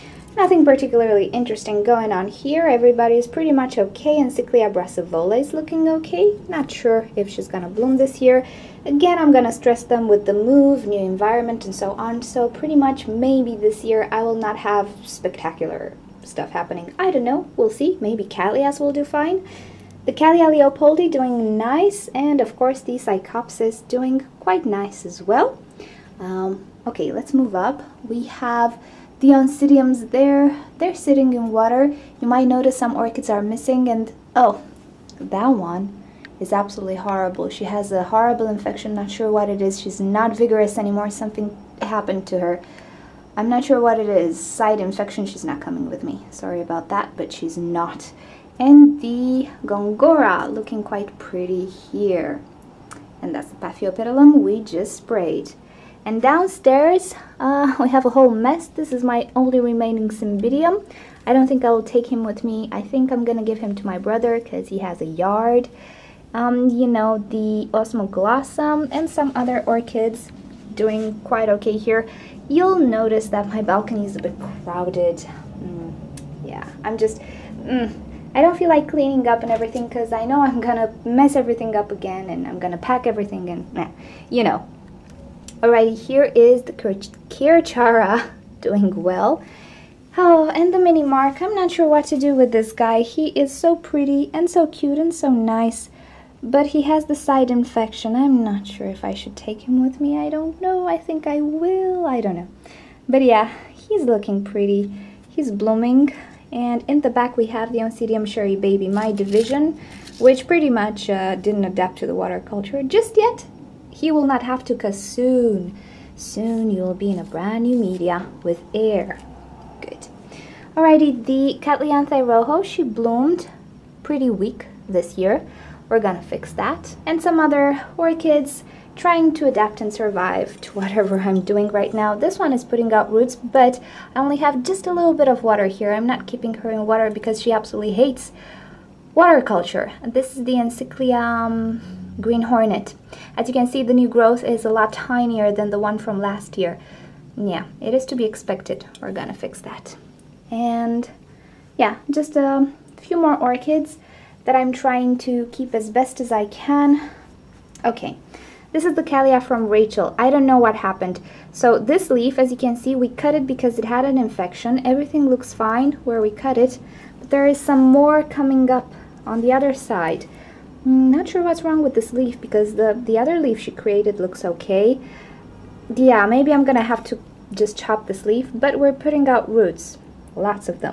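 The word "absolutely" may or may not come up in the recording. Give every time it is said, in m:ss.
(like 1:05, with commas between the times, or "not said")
0:36, 2:17.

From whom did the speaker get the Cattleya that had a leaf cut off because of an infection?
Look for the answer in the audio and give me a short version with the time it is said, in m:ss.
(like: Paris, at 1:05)
Rachel, at 2:39.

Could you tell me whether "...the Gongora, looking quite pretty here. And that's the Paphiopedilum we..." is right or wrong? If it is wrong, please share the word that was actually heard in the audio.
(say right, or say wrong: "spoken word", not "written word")
right.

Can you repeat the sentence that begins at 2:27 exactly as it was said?
Yeah, it is to be expected.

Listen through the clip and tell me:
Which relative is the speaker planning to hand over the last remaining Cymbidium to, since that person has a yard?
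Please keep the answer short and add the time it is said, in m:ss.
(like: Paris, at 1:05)
brother, at 1:03.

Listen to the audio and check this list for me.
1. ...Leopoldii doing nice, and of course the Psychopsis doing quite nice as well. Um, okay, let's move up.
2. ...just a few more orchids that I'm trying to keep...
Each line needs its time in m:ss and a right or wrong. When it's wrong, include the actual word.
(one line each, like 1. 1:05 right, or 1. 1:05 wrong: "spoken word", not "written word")
1. 0:20 right
2. 2:32 right.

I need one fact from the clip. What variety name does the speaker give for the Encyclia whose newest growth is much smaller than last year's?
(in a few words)
Green Hornet.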